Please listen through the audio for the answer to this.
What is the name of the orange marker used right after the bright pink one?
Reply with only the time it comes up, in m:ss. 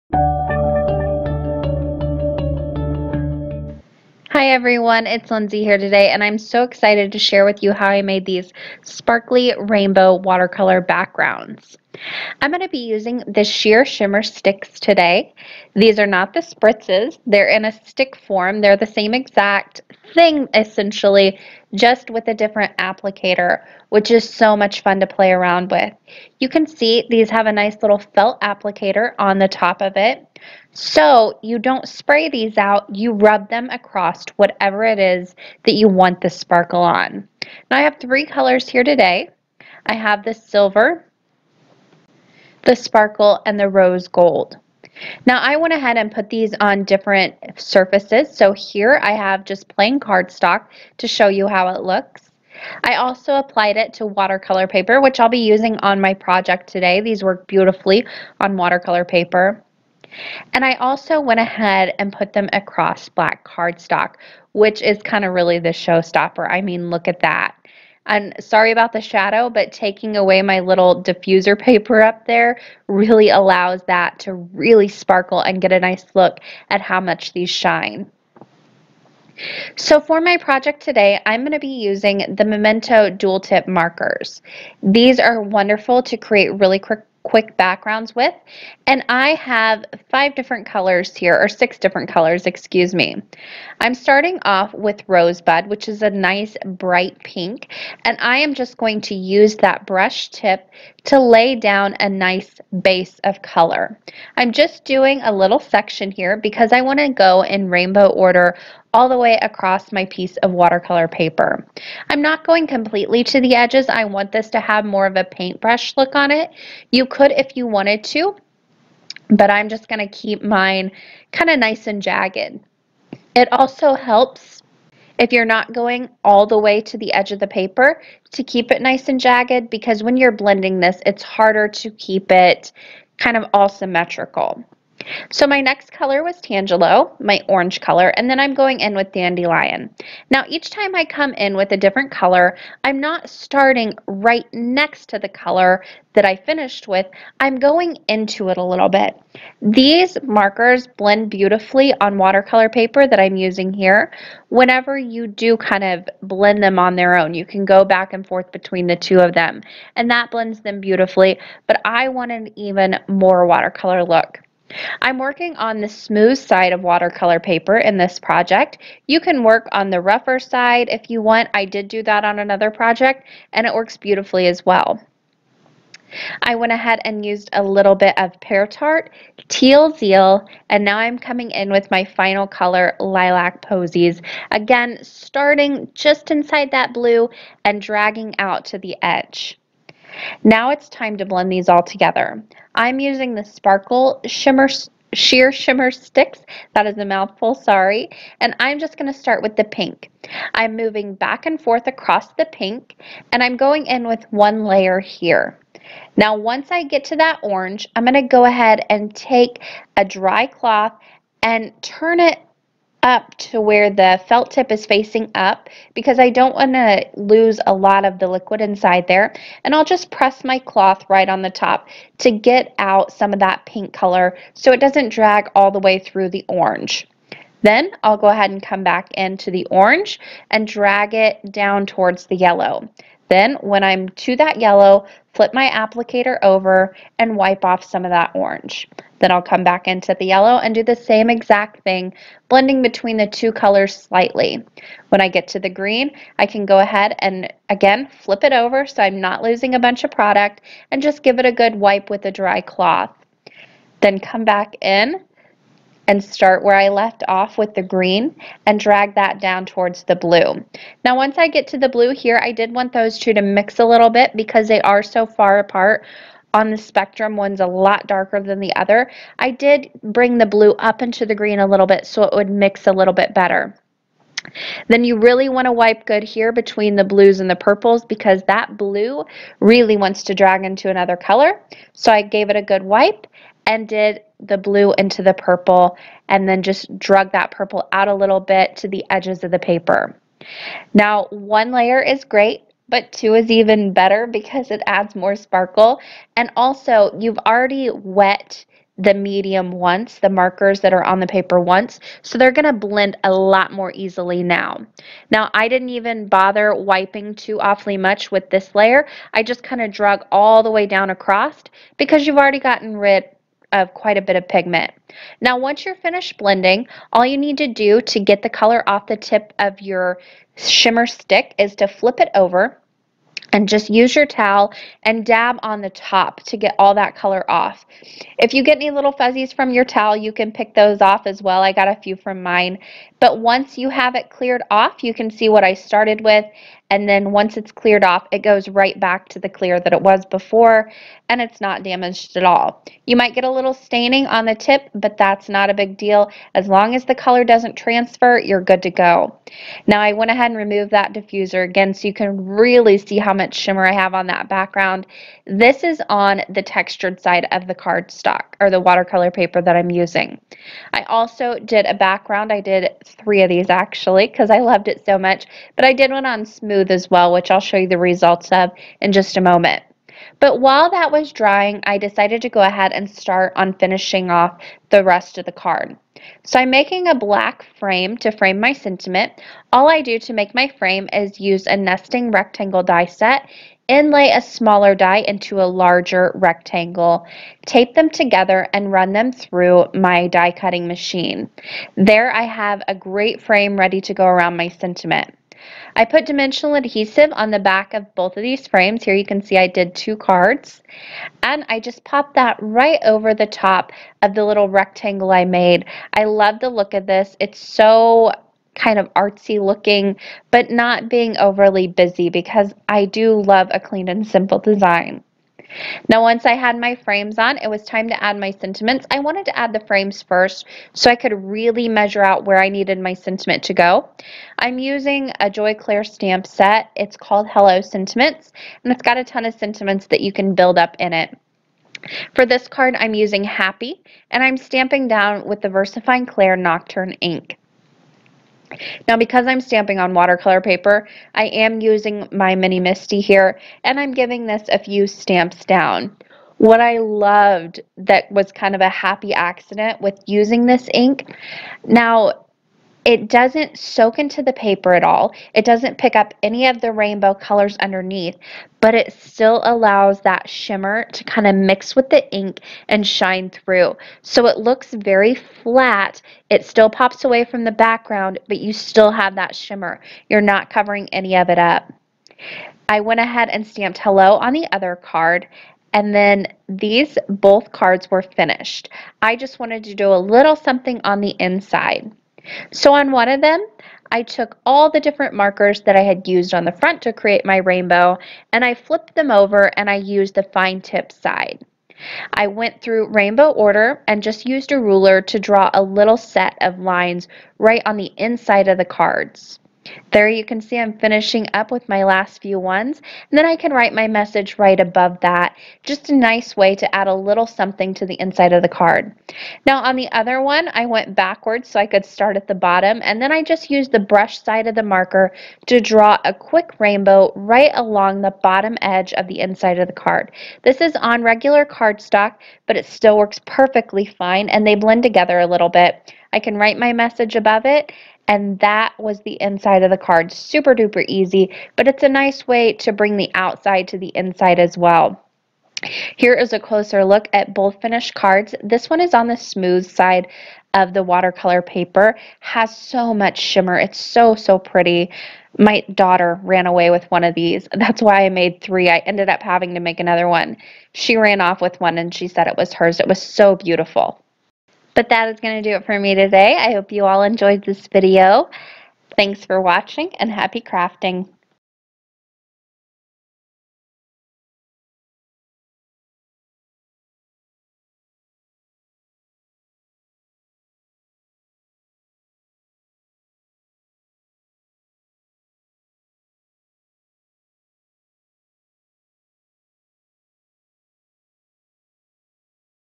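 2:16.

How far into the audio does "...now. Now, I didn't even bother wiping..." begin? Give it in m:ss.
5:04.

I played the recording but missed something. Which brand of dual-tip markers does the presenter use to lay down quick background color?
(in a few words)
Memento.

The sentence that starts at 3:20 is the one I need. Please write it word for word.
I'm moving back and forth across the pink, and I'm going in with one layer here.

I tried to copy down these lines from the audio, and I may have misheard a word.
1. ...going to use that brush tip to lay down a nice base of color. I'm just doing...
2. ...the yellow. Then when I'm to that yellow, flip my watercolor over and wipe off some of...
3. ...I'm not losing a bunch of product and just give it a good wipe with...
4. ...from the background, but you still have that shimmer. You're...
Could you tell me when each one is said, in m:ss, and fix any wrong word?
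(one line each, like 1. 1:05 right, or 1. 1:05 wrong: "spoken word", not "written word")
1. 1:38 right
2. 3:52 wrong: "applicator", not "watercolor"
3. 4:09 right
4. 7:47 right.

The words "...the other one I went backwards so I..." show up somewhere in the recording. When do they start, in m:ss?
8:29.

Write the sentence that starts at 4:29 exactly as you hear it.
I did bring the blue up into the green a little bit so it would mix a little bit better.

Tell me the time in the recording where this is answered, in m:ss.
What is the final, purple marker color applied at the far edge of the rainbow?
3:02.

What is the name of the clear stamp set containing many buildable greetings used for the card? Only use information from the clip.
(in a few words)
Hello Sentiments.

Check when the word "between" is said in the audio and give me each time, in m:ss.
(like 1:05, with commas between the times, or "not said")
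2:38, 4:02, 4:36.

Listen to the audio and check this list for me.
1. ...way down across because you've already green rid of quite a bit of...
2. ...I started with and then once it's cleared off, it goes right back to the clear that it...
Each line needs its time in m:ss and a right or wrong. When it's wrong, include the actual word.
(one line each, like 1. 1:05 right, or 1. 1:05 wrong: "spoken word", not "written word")
1. 5:10 wrong: "gotten", not "green"
2. 5:35 right.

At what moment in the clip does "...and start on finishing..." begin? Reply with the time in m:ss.
6:12.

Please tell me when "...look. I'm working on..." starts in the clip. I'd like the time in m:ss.
2:44.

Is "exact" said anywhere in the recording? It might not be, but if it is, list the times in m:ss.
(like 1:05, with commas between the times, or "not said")
0:19, 4:01.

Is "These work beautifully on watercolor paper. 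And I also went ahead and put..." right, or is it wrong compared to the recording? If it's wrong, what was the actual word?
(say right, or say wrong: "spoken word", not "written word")
right.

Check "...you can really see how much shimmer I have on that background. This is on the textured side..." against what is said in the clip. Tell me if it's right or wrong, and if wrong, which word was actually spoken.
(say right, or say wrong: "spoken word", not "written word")
right.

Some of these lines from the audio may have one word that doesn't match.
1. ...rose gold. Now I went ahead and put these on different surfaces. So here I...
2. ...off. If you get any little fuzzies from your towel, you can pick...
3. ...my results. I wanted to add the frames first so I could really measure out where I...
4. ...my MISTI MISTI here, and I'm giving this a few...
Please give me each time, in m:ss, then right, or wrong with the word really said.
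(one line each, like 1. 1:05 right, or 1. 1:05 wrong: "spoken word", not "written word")
1. 0:43 right
2. 5:27 right
3. 6:58 wrong: "sentiments", not "results"
4. 7:22 wrong: "Mini", not "MISTI".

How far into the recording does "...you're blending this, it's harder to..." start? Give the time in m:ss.
2:10.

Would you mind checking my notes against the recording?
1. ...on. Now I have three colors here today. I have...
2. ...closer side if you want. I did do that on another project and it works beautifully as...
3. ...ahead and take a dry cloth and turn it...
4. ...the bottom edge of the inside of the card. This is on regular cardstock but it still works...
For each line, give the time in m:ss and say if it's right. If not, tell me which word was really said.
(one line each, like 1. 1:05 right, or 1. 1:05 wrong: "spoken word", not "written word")
1. 0:36 right
2. 2:50 wrong: "rougher", not "closer"
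3. 3:28 right
4. 8:38 right.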